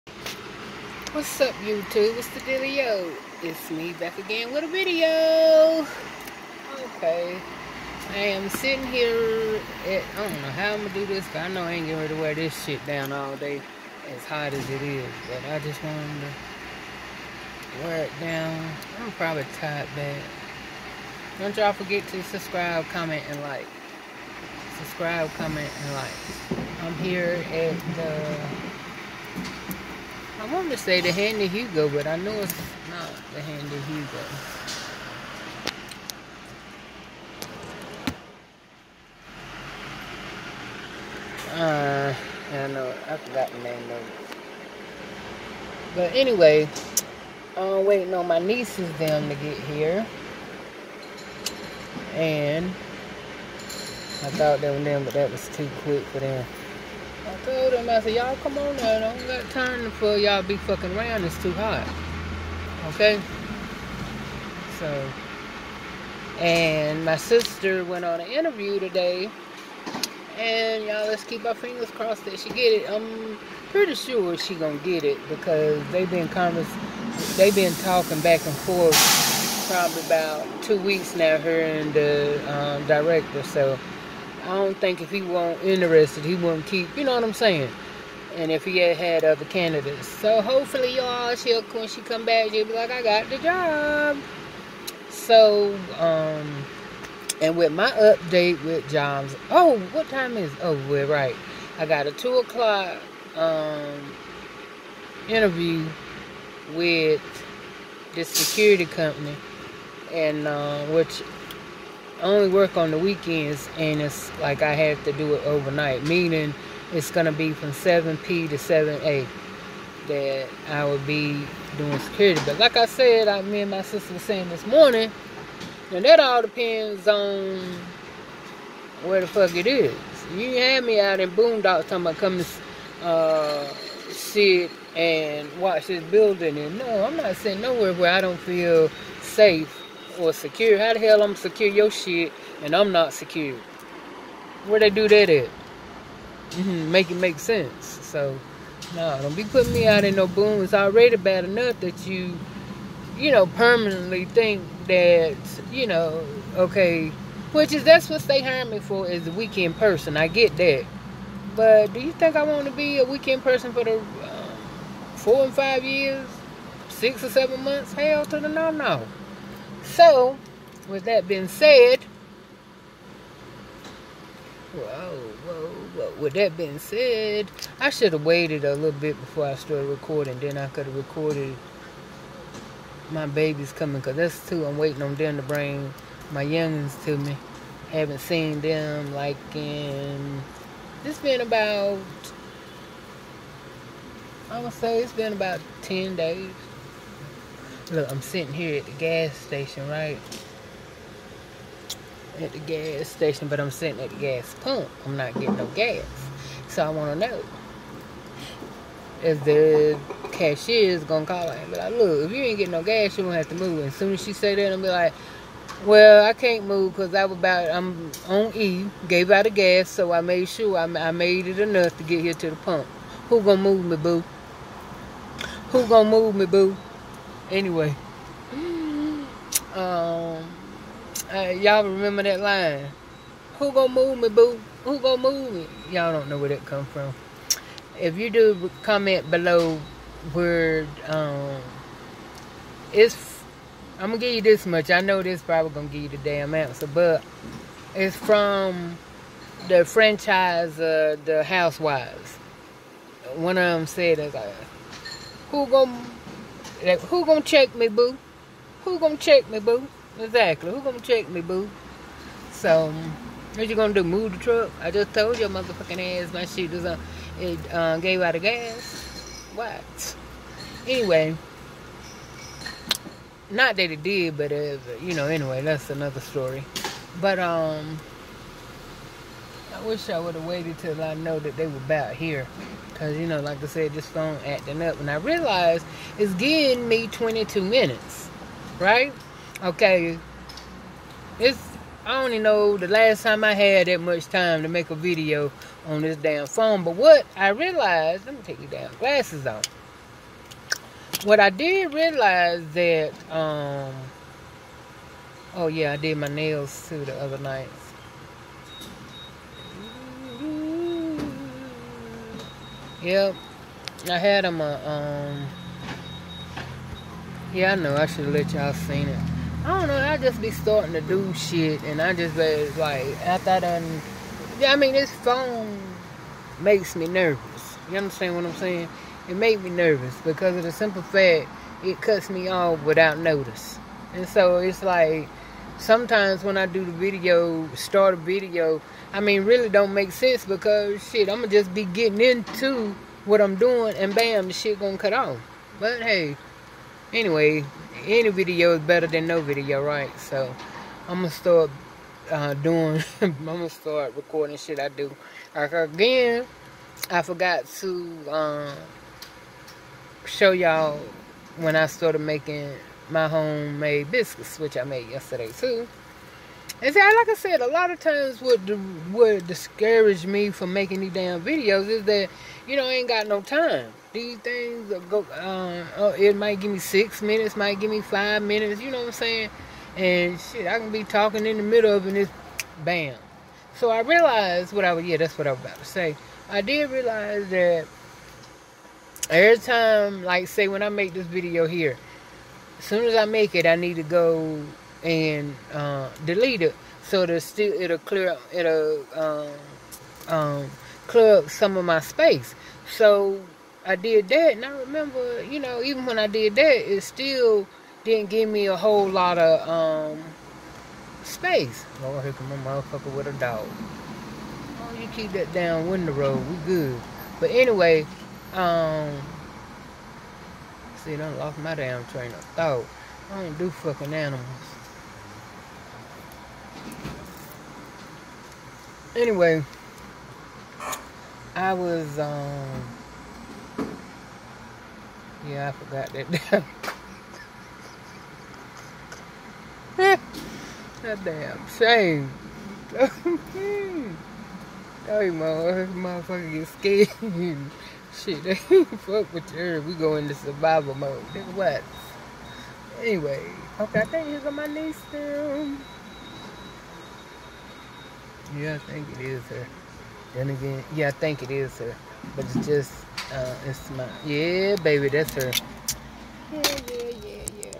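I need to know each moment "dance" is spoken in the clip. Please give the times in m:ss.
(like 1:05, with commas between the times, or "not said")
not said.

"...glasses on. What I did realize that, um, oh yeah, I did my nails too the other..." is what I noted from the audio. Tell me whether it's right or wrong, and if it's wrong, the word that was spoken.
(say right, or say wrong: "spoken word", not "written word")
right.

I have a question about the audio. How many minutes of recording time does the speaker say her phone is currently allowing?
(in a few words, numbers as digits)
22 minutes.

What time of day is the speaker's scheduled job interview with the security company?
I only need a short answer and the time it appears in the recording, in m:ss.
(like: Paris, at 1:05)
2:00, at 1:42.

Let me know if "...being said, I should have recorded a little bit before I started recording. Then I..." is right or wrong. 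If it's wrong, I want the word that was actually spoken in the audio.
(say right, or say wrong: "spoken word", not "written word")
wrong: "waited", not "recorded".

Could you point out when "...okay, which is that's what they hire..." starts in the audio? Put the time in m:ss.
2:36.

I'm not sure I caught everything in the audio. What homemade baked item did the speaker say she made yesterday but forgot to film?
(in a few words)
biscuits.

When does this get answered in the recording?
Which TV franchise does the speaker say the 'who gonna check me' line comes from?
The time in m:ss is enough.
4:11.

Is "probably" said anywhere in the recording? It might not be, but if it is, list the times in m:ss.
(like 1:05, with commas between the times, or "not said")
0:19, 1:19, 4:05.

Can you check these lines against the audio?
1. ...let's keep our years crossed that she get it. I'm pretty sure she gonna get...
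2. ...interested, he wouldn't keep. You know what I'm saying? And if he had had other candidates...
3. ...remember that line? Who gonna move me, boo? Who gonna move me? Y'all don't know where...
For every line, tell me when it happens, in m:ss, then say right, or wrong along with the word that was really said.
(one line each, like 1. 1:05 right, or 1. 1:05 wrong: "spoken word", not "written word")
1. 1:11 wrong: "fingers", not "years"
2. 1:25 right
3. 3:51 right.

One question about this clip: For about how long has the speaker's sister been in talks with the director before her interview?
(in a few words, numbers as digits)
2 weeks.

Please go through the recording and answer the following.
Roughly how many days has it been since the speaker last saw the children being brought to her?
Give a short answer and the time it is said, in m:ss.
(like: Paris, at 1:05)
10 days, at 3:15.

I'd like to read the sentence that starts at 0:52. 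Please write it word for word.
And I thought they were them, but that was too quick for them told him, I said, y'all come on now.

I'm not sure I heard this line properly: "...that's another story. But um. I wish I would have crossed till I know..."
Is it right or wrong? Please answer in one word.
wrong.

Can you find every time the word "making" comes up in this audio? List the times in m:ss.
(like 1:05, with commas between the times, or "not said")
6:02, 6:10.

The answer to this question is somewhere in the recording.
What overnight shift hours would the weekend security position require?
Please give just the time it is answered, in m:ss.
1:57.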